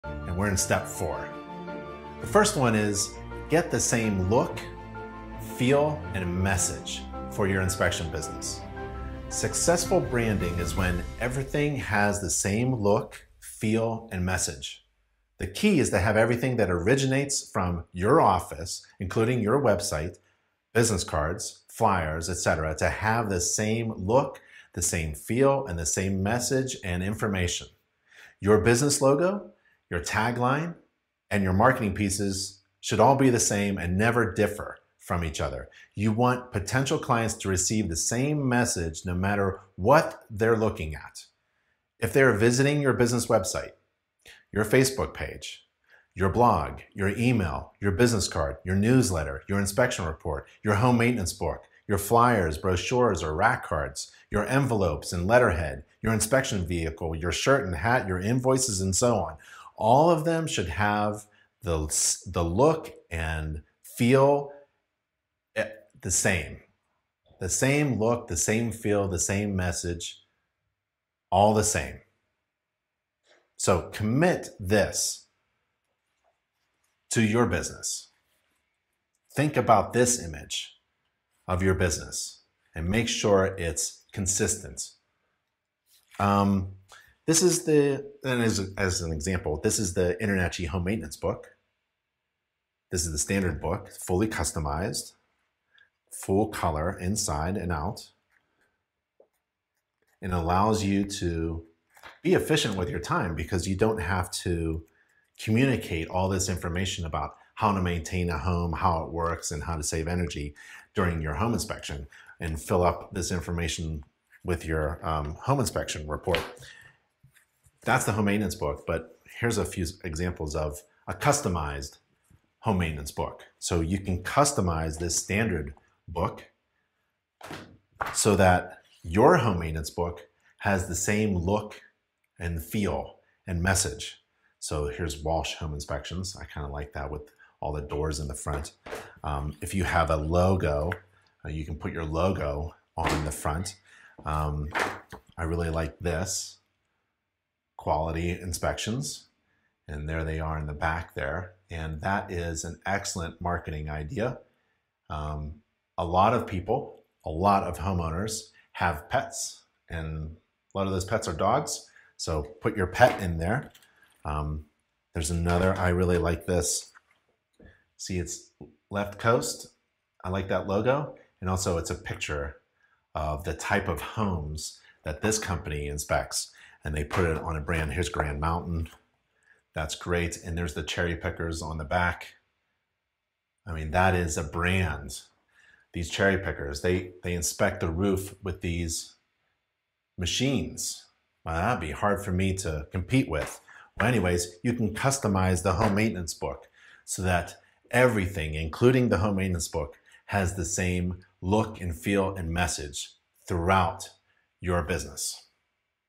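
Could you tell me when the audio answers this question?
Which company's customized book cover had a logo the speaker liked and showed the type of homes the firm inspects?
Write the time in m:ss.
2:48.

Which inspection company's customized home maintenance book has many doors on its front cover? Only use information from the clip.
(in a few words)
Walsh Home Inspections.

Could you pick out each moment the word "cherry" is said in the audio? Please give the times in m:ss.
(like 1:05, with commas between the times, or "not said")
3:00, 3:06.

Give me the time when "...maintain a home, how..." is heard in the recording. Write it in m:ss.
1:47.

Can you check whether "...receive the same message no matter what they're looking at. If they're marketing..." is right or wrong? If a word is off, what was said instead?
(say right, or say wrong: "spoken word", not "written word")
wrong: "visiting", not "marketing".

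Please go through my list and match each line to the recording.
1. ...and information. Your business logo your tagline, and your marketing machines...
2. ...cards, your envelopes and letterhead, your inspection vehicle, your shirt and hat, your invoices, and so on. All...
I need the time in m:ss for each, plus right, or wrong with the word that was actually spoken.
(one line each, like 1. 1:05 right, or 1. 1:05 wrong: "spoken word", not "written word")
1. 0:26 wrong: "pieces", not "machines"
2. 0:53 right.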